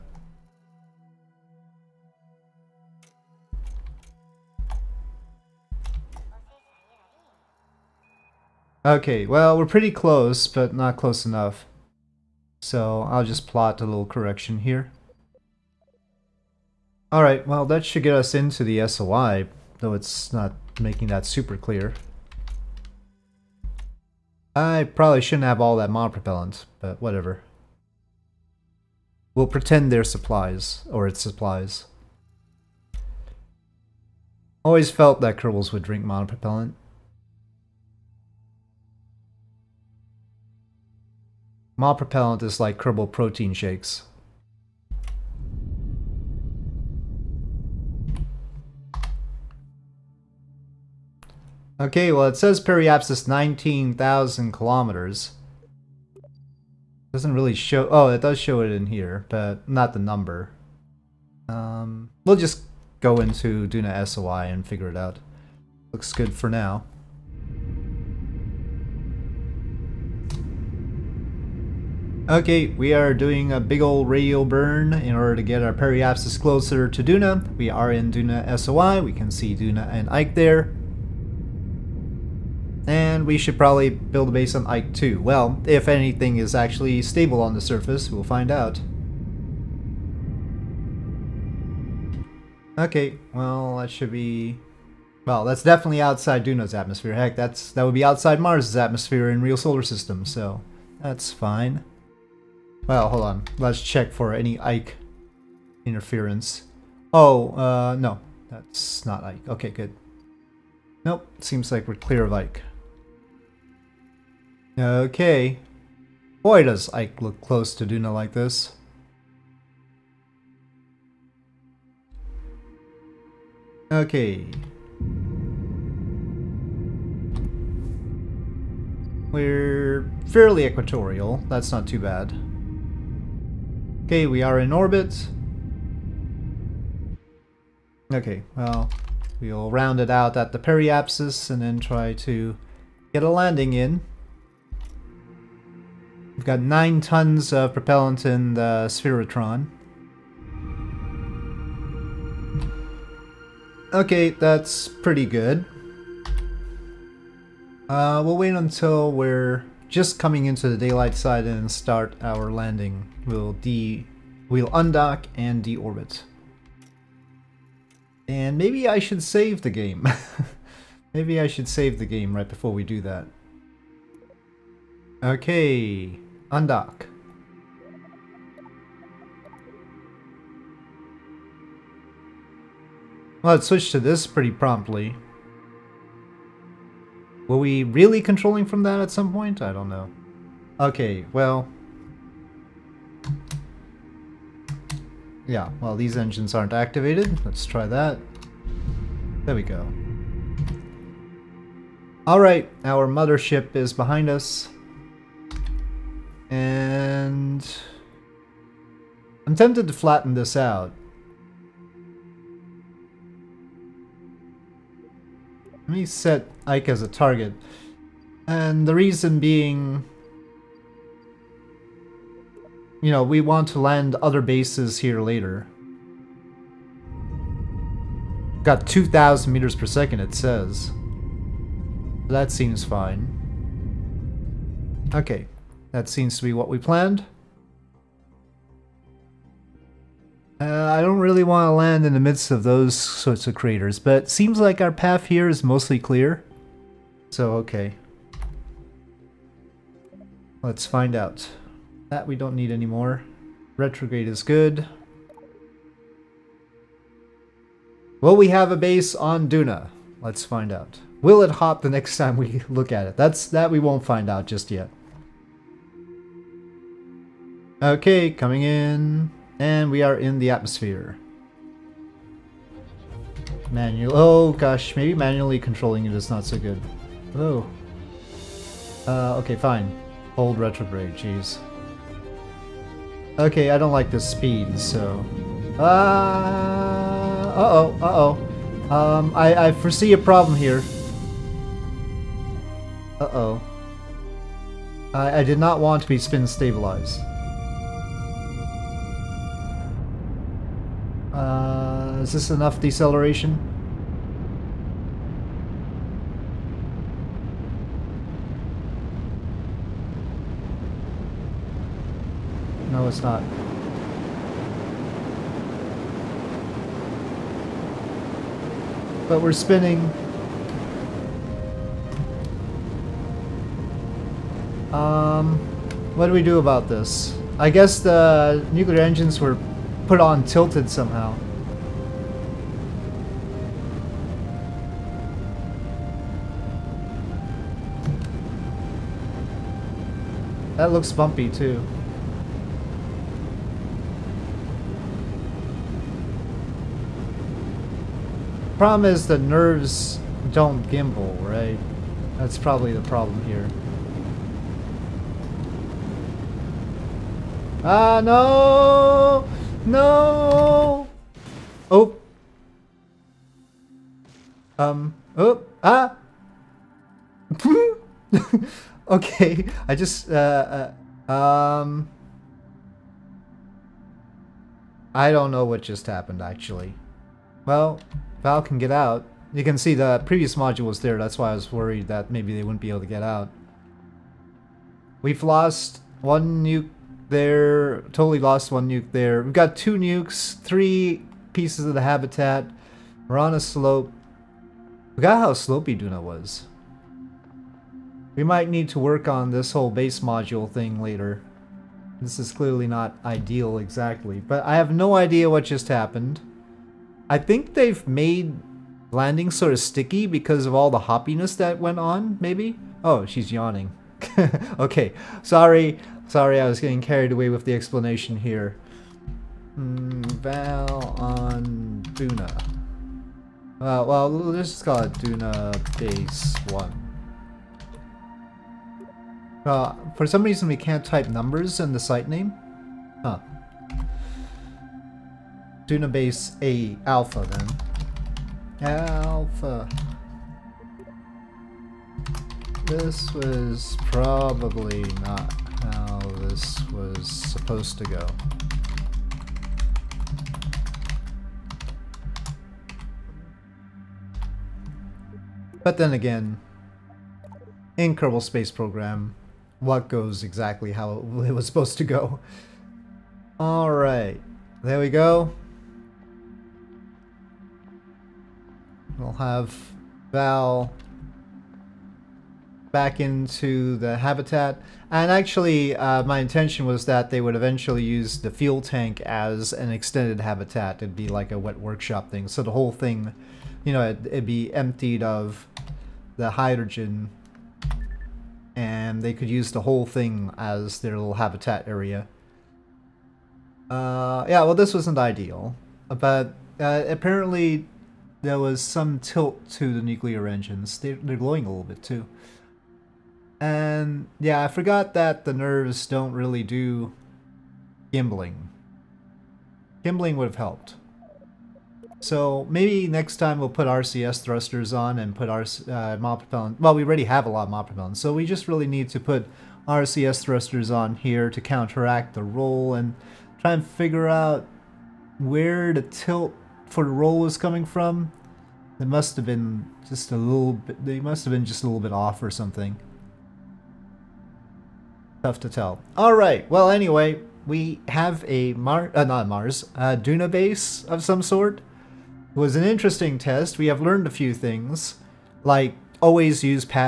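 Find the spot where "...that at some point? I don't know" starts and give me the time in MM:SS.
03:08.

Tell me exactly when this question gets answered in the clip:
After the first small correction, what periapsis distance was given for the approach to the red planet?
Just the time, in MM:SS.
00:53.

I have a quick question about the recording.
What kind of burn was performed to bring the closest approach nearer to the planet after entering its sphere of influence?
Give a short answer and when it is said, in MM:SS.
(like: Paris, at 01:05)
Radial burn, at 01:14.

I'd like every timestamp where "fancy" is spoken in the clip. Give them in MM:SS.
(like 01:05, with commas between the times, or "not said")
not said.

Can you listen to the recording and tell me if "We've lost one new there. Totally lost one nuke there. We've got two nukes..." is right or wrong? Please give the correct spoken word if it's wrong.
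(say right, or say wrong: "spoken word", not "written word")
right.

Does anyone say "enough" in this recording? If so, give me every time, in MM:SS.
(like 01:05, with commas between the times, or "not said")
00:11, 05:02.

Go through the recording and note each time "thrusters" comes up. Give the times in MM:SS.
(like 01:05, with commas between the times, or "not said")
08:34, 08:40.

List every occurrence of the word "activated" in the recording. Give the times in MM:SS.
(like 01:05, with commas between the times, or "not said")
03:16.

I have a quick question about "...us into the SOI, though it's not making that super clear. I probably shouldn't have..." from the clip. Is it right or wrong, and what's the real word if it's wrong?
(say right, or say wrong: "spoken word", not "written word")
right.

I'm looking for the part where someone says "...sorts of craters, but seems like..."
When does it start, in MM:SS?
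04:02.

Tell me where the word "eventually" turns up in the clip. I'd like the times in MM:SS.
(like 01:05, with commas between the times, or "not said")
07:57.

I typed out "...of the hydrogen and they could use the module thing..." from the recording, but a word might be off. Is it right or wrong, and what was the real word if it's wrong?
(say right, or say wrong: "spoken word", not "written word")
wrong: "whole", not "module".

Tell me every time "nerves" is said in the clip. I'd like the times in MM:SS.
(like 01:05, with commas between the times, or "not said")
05:49, 08:25.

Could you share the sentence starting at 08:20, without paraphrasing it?
They're, they're glowing a little bit too.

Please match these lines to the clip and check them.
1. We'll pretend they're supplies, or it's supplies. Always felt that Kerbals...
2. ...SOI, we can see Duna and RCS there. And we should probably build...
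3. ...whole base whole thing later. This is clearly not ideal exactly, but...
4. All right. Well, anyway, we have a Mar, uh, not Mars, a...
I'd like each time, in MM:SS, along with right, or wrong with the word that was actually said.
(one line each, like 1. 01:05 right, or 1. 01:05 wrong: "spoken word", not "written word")
1. 00:29 right
2. 01:18 wrong: "Ike", not "RCS"
3. 06:39 wrong: "module", not "whole"
4. 08:56 right.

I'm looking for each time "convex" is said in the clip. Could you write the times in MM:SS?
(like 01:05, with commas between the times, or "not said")
not said.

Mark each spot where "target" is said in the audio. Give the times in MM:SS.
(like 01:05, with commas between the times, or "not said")
03:37.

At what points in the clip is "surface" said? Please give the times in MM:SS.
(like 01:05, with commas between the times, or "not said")
01:27.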